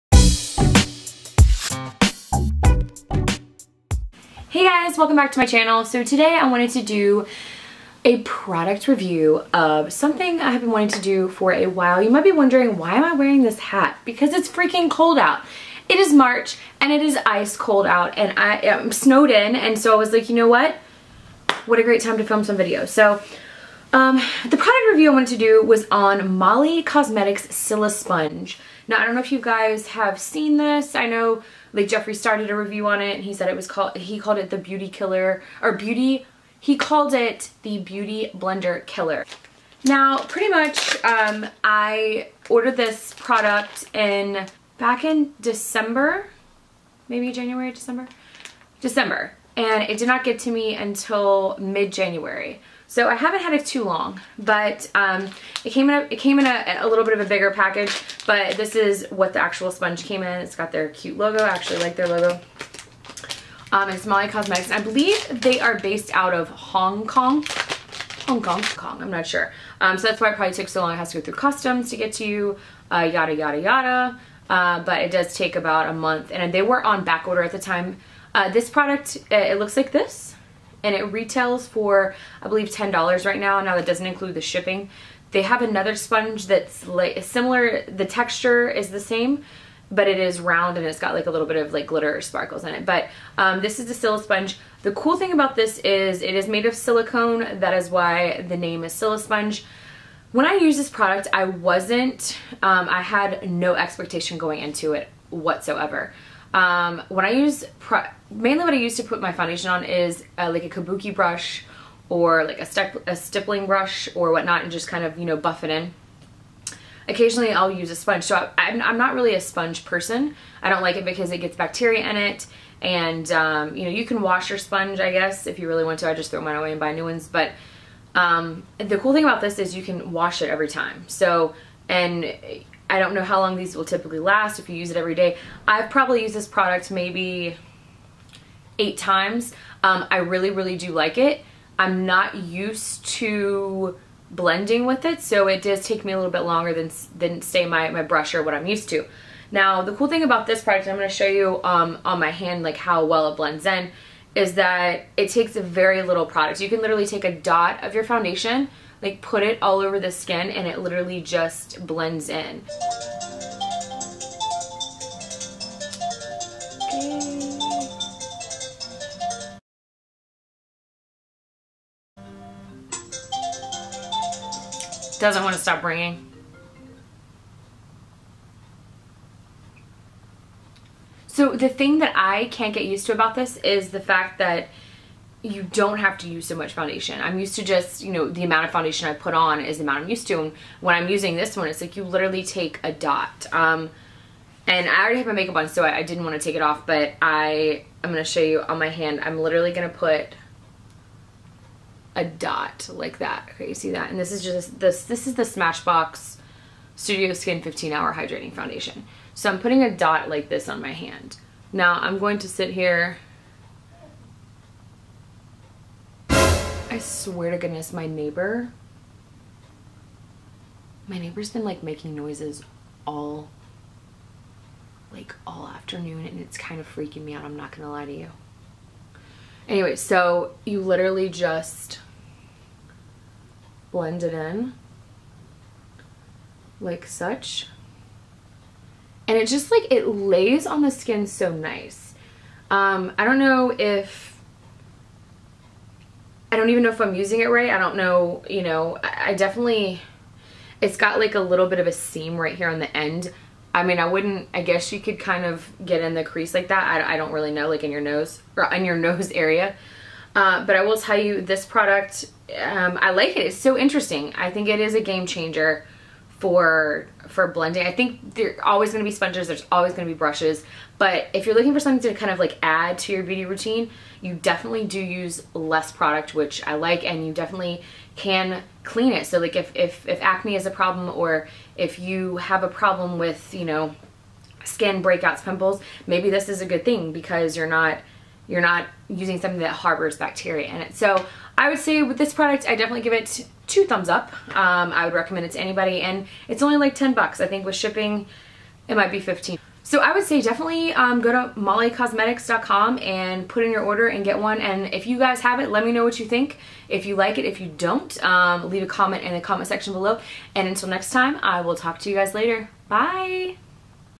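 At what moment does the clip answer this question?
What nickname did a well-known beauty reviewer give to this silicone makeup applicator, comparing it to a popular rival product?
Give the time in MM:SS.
00:37.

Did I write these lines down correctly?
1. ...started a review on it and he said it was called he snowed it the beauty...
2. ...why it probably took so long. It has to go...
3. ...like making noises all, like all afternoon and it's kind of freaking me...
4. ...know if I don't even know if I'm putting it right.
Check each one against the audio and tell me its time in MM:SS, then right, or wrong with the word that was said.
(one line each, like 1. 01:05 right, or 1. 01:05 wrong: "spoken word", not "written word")
1. 00:32 wrong: "called", not "snowed"
2. 01:10 right
3. 03:41 right
4. 04:03 wrong: "using", not "putting".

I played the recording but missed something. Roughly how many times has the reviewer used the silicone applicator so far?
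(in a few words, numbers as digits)
8.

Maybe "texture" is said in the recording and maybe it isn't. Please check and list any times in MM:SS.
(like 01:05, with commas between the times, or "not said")
01:28.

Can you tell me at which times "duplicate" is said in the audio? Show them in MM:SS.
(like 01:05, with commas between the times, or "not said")
not said.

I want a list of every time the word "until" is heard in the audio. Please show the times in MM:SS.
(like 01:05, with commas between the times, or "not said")
00:50, 05:10.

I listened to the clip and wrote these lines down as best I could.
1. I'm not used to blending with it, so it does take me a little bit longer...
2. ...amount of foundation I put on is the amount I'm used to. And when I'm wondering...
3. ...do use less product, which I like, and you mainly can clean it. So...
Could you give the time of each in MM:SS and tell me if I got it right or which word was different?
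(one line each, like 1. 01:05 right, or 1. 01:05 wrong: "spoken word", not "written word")
1. 02:21 right
2. 03:08 wrong: "using", not "wondering"
3. 04:34 wrong: "definitely", not "mainly".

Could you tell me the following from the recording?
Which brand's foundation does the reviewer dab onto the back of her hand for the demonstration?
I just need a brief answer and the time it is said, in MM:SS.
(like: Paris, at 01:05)
Smashbox, at 03:25.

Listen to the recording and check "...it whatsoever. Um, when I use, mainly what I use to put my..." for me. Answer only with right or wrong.
right.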